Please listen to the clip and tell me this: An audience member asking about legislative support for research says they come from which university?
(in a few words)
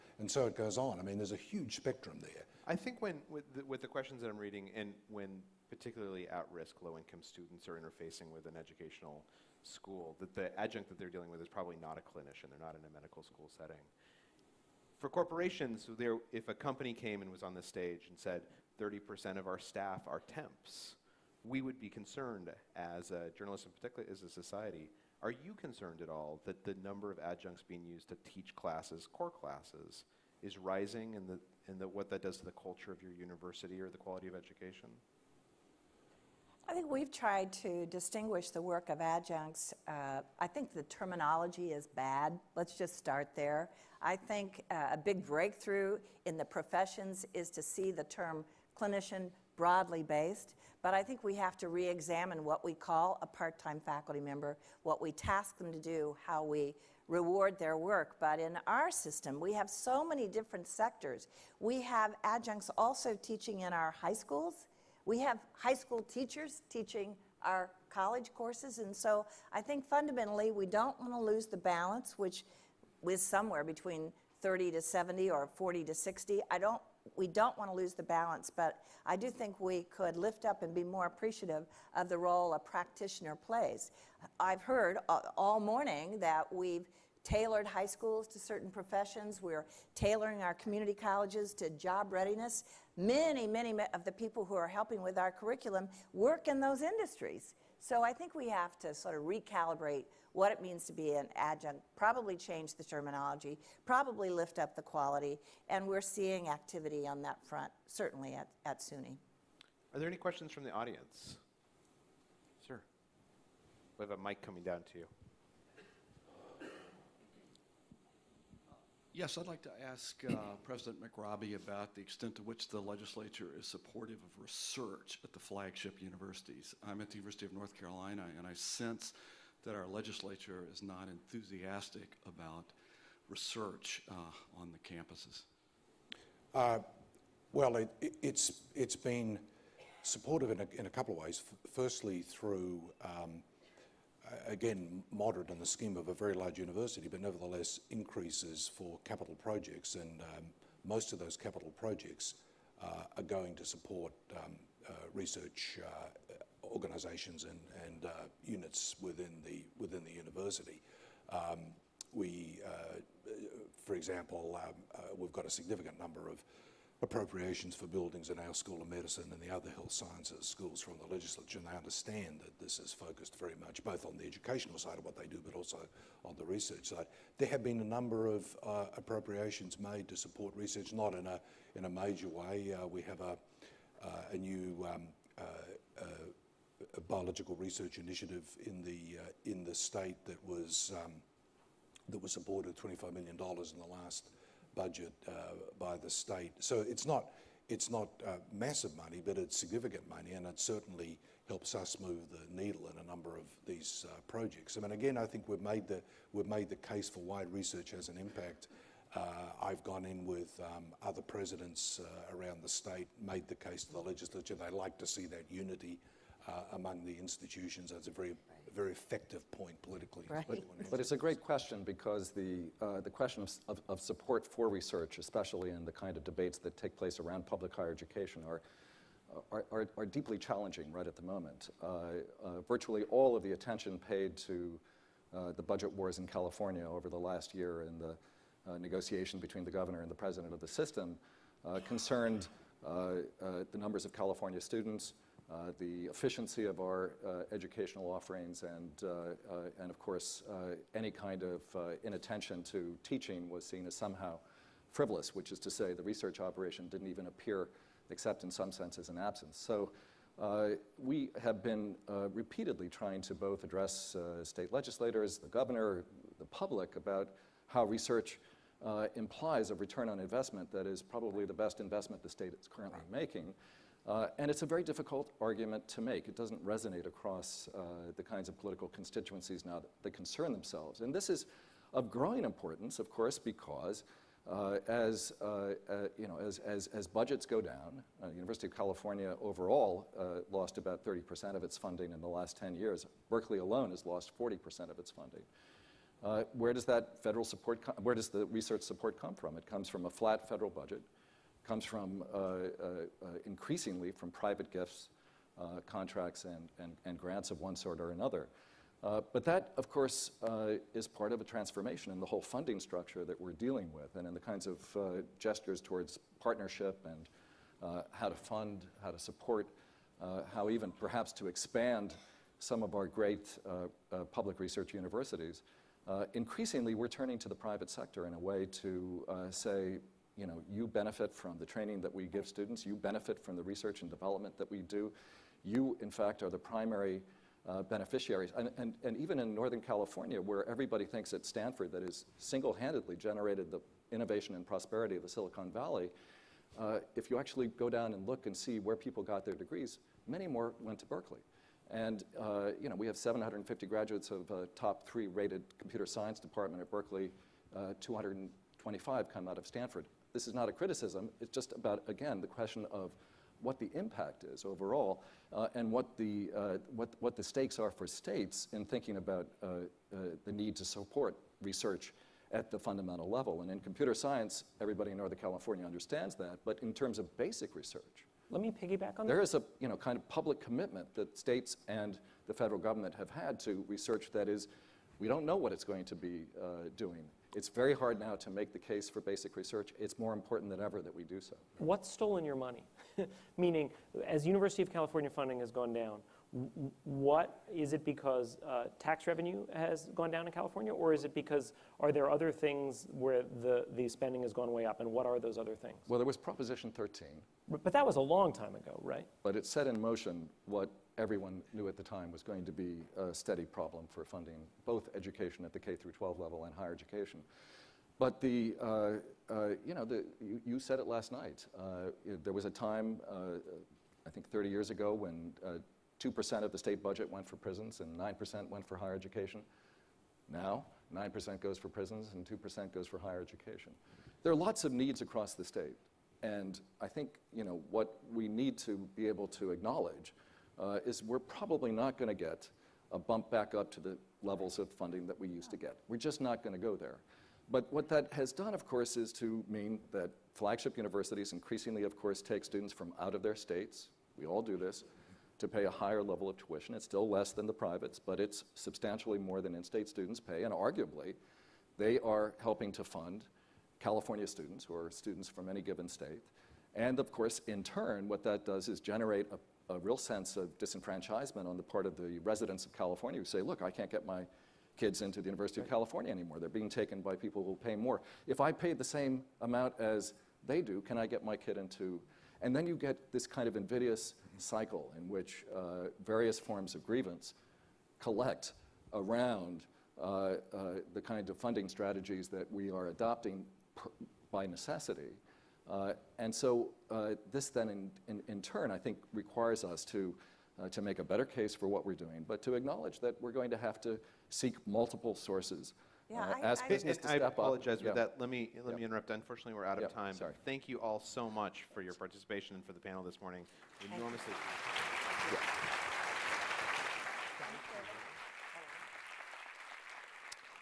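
University of North Carolina.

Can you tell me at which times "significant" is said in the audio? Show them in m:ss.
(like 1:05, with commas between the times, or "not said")
2:45, 3:19.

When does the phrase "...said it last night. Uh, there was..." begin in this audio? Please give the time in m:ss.
7:00.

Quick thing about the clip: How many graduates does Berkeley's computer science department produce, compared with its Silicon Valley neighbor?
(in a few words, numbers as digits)
750.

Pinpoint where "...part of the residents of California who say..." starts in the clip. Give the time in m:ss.
7:51.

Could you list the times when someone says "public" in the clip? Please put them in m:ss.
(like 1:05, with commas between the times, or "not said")
3:47, 4:26, 5:24, 6:20.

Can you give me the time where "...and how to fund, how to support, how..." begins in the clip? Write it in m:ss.
5:17.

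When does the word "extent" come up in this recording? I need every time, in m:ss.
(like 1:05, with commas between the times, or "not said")
2:02.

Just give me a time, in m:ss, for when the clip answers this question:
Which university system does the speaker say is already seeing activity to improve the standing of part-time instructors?
1:48.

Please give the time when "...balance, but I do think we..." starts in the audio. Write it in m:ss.
1:18.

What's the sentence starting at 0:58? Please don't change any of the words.
But in our system, we have so many different sectors.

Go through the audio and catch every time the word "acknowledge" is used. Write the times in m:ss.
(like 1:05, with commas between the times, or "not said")
7:19, 8:22.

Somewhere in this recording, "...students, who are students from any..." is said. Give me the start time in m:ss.
7:44.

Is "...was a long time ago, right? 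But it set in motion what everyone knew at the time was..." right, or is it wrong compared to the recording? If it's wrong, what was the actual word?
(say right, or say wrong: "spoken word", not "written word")
right.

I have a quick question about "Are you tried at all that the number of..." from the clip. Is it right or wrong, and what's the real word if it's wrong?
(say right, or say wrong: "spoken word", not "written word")
wrong: "concerned", not "tried".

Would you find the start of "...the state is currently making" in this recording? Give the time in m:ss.
4:32.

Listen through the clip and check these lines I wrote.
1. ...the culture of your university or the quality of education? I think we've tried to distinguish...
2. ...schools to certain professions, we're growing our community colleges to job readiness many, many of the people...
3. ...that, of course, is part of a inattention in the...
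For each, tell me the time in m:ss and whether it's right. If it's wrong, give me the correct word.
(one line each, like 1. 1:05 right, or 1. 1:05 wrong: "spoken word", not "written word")
1. 0:32 right
2. 1:27 wrong: "tailoring", not "growing"
3. 5:09 wrong: "transformation", not "inattention".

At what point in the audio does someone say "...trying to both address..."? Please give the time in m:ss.
4:22.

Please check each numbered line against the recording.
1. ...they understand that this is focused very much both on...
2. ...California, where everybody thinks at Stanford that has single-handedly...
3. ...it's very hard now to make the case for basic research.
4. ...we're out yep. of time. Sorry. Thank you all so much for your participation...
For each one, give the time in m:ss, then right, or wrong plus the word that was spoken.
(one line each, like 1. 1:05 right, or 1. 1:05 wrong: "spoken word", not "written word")
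1. 2:51 right
2. 5:39 right
3. 6:27 right
4. 8:29 right.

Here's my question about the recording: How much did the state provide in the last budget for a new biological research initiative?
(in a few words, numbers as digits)
$25 million.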